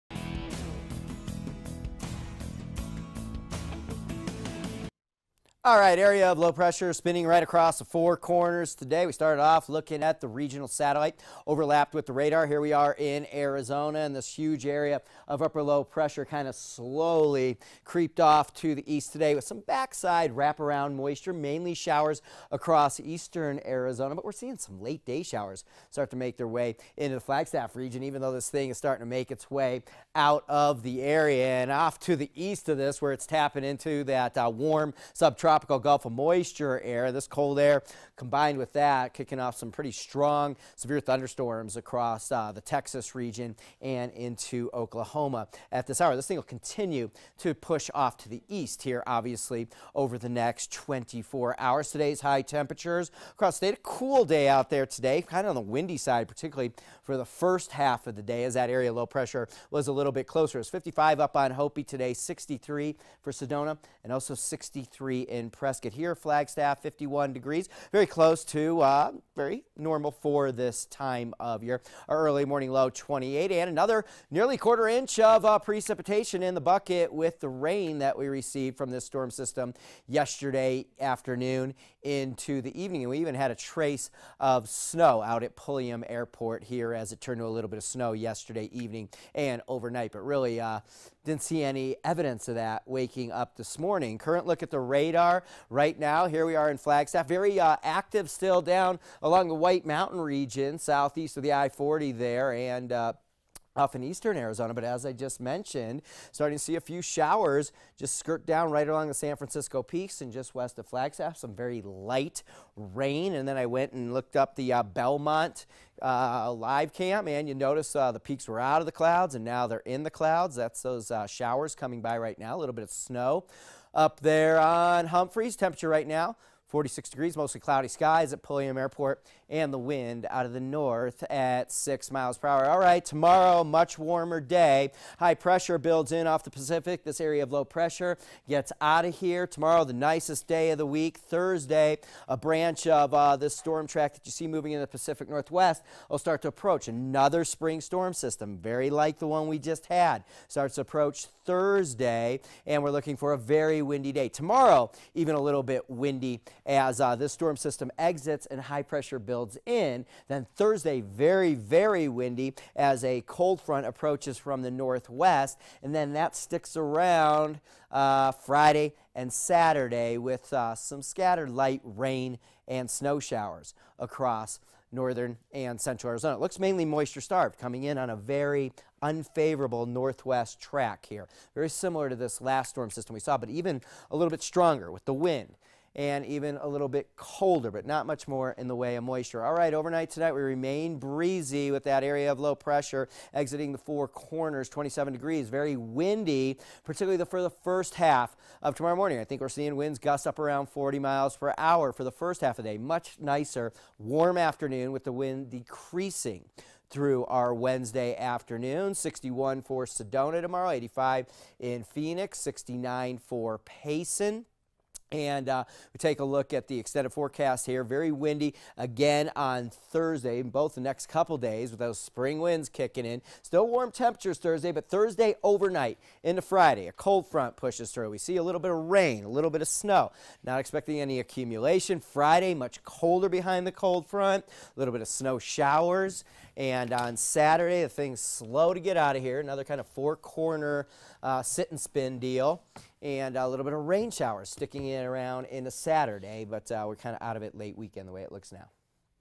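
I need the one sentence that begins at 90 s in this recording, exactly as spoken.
But really, uh, didn't see any evidence of that waking up this morning.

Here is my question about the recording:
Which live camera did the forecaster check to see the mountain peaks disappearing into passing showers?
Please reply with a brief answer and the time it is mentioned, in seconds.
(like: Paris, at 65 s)
Bellemont, at 114 s.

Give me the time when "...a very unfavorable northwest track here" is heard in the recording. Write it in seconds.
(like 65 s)
178 s.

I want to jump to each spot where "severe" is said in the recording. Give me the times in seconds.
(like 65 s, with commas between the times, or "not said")
40 s.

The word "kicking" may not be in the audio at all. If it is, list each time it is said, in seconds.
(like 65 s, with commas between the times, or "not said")
39 s, 222 s.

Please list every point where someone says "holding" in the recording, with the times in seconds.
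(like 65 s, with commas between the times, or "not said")
not said.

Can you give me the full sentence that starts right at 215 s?
And uh, we take a look at the extended forecast here.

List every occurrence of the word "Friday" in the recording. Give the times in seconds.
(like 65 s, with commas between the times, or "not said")
168 s, 226 s, 231 s.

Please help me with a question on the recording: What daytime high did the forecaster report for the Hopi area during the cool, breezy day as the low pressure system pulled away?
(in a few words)
55.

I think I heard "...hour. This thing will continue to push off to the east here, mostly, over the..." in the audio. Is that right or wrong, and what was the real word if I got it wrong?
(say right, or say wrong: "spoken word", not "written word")
wrong: "obviously", not "mostly".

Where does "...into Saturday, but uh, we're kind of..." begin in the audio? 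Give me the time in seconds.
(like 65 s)
245 s.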